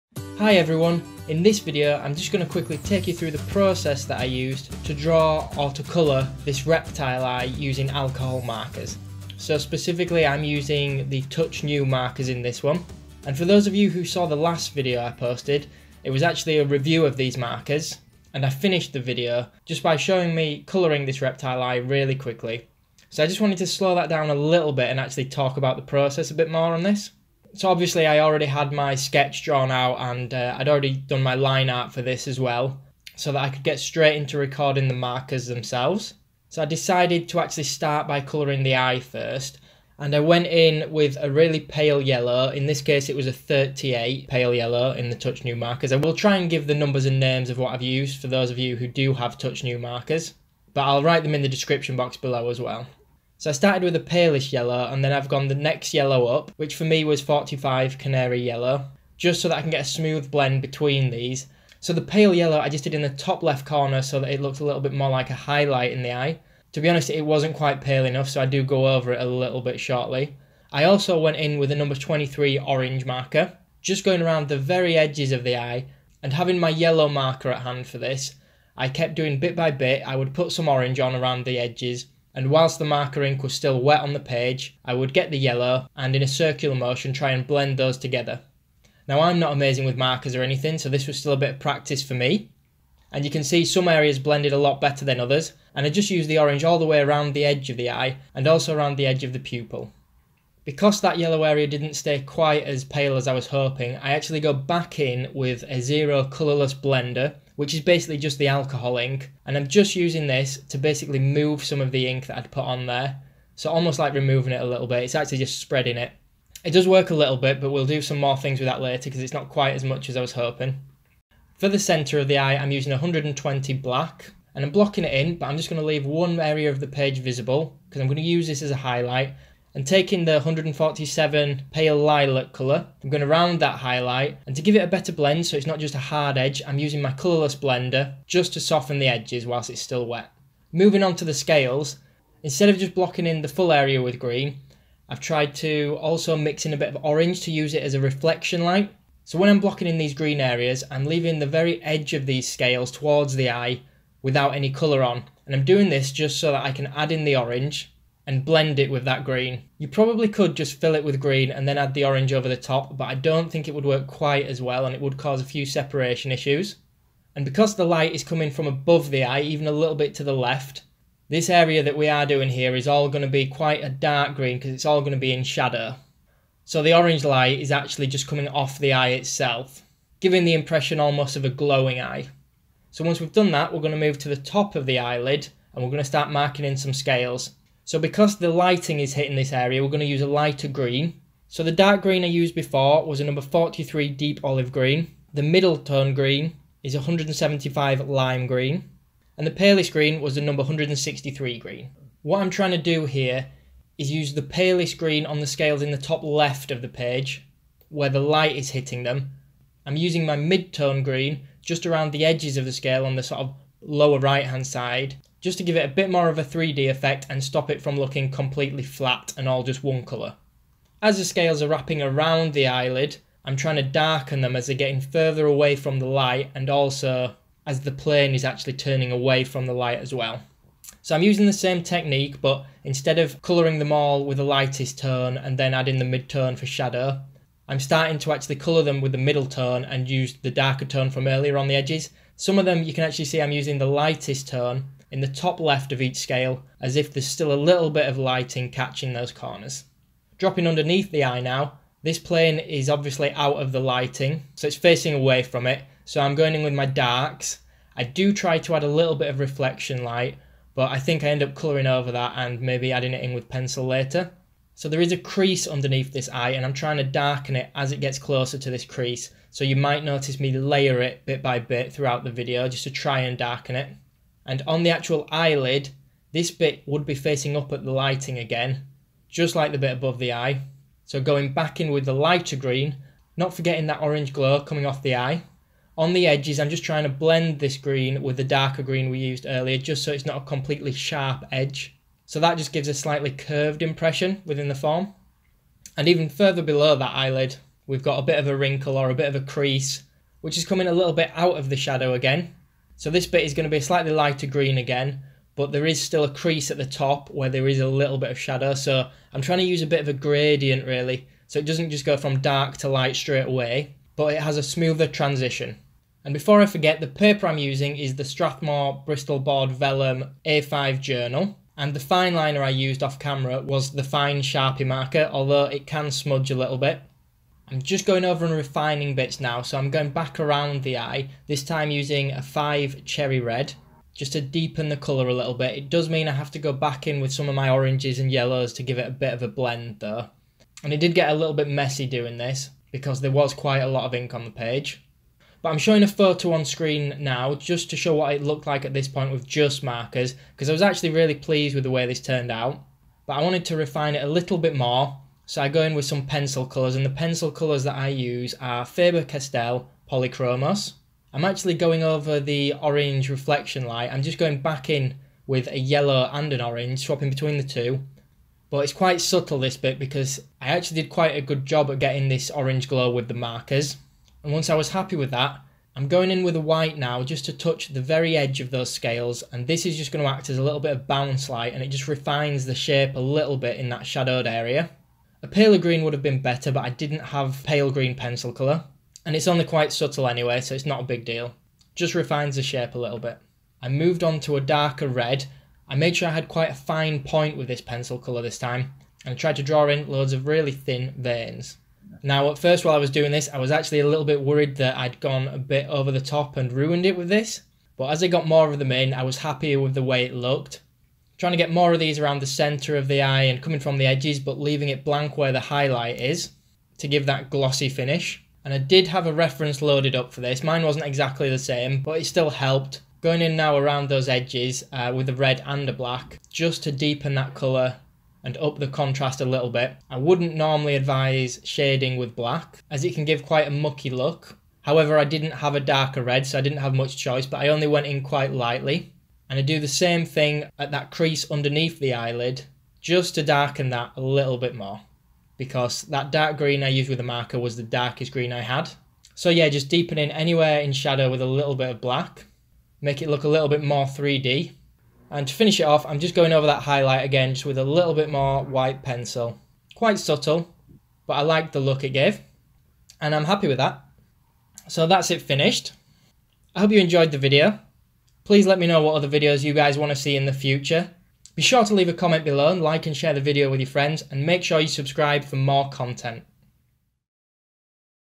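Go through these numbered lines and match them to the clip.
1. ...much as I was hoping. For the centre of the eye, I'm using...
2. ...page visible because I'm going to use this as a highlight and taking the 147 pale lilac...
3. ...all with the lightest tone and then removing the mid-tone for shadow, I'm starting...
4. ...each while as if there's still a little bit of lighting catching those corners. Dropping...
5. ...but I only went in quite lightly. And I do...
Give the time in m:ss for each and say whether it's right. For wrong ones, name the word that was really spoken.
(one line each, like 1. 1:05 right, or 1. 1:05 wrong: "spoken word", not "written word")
1. 1:59 right
2. 2:06 right
3. 3:53 wrong: "adding", not "removing"
4. 4:06 wrong: "scale", not "while"
5. 7:17 right.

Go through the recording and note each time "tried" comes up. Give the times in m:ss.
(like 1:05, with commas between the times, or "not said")
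2:25, 6:39.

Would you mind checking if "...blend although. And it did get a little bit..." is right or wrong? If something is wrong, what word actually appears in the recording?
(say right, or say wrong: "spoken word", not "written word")
wrong: "though", not "although".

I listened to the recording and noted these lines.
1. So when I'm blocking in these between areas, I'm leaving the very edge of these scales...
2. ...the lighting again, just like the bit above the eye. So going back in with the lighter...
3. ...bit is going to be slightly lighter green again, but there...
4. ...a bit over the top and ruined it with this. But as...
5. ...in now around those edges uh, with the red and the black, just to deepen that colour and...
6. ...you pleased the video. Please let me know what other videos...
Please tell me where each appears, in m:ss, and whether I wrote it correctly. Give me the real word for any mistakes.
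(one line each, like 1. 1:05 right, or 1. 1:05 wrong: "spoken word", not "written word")
1. 2:29 wrong: "green", not "between"
2. 4:37 right
3. 5:03 right
4. 6:45 right
5. 7:03 right
6. 7:46 wrong: "enjoyed", not "pleased".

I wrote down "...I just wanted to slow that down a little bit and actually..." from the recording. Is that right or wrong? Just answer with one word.
right.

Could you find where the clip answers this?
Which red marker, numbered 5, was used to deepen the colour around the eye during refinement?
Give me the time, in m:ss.
5:33.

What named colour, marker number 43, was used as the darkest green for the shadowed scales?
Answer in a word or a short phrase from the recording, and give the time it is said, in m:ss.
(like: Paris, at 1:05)
deep olive green, at 3:14.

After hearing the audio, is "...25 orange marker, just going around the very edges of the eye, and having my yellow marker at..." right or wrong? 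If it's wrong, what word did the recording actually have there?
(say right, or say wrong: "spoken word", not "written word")
wrong: "23", not "25".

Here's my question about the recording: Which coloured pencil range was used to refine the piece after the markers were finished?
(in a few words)
Faber-Castell Polychromos.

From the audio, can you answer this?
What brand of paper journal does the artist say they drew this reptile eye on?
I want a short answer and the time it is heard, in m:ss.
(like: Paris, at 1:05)
Strathmore, at 5:18.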